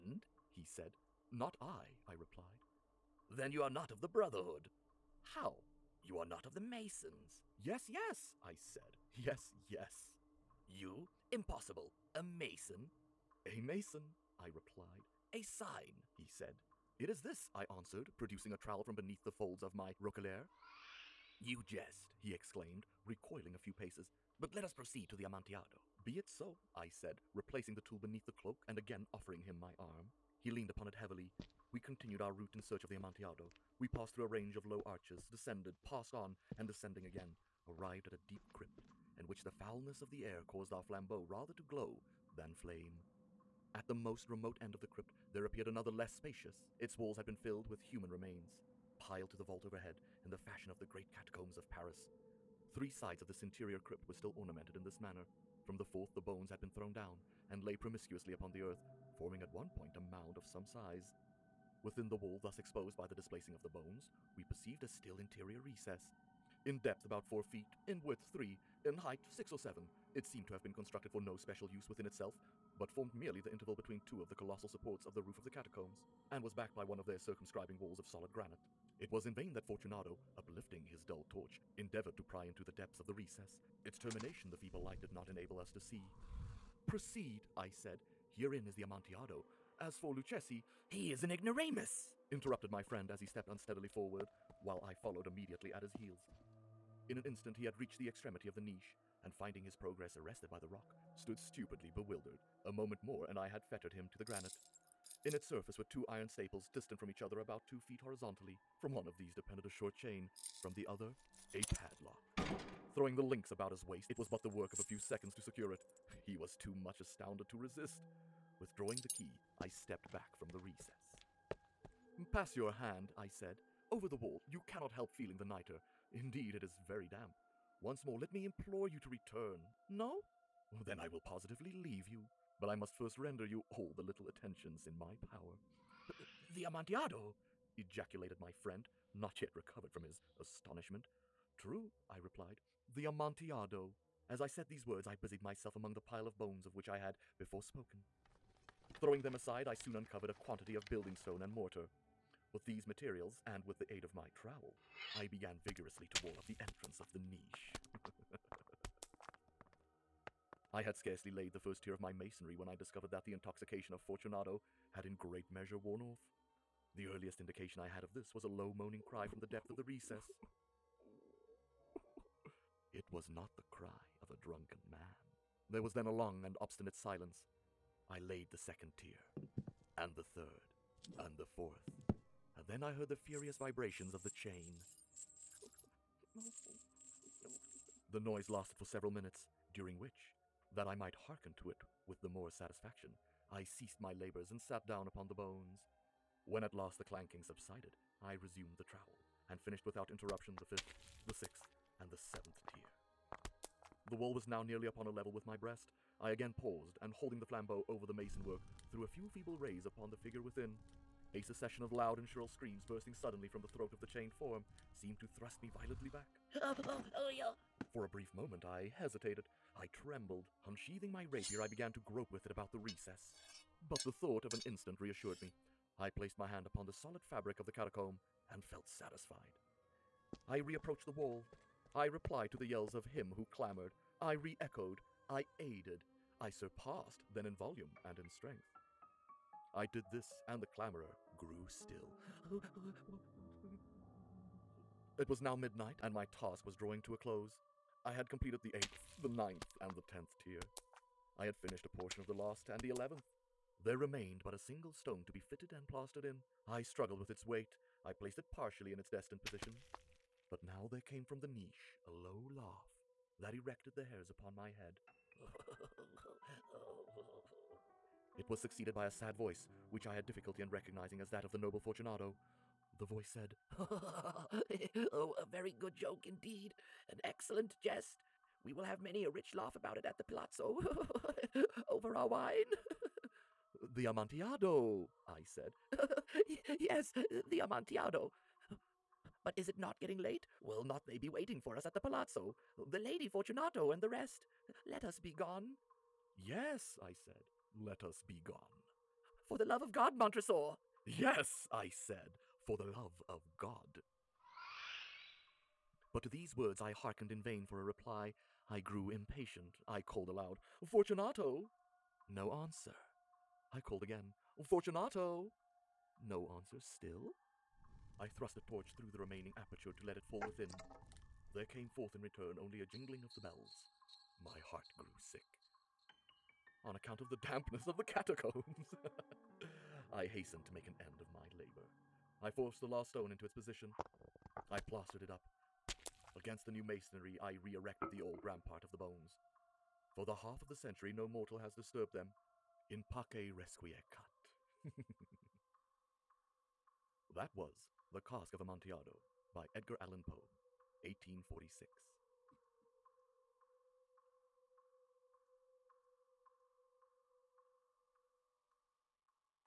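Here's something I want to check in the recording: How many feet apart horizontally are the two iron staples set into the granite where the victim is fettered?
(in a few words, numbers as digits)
2 feet.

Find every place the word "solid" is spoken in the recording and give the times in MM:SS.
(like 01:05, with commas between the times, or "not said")
01:18, 03:46.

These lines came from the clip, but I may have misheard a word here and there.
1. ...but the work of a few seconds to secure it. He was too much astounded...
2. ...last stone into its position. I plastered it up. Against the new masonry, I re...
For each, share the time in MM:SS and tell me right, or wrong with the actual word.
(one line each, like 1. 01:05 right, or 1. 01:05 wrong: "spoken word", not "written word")
1. 01:54 right
2. 05:32 right.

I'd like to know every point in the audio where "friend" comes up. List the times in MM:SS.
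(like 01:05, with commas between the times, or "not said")
01:32, 02:18.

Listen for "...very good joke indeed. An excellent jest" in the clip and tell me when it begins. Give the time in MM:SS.
04:35.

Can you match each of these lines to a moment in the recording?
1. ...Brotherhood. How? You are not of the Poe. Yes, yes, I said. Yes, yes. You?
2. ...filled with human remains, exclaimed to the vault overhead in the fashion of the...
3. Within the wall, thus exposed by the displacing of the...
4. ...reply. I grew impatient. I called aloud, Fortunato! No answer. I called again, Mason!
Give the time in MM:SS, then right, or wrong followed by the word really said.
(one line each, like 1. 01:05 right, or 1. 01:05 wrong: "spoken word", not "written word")
1. 00:04 wrong: "Masons", not "Poe"
2. 00:47 wrong: "piled", not "exclaimed"
3. 01:01 right
4. 05:07 wrong: "Fortunato", not "Mason".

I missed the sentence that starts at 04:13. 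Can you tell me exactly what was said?
There remained but a single stone to be fitted and plastered in.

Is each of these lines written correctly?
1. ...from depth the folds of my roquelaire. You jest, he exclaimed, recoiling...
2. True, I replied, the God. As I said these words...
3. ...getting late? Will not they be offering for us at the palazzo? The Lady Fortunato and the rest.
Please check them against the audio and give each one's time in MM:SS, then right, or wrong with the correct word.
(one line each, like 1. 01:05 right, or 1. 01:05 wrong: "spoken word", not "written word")
1. 00:18 wrong: "beneath", not "depth"
2. 02:21 wrong: "Amontillado", not "God"
3. 04:50 wrong: "waiting", not "offering".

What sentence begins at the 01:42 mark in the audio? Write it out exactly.
A moment more, and I had fettered him to the granite.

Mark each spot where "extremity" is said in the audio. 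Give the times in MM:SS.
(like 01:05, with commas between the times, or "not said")
01:38.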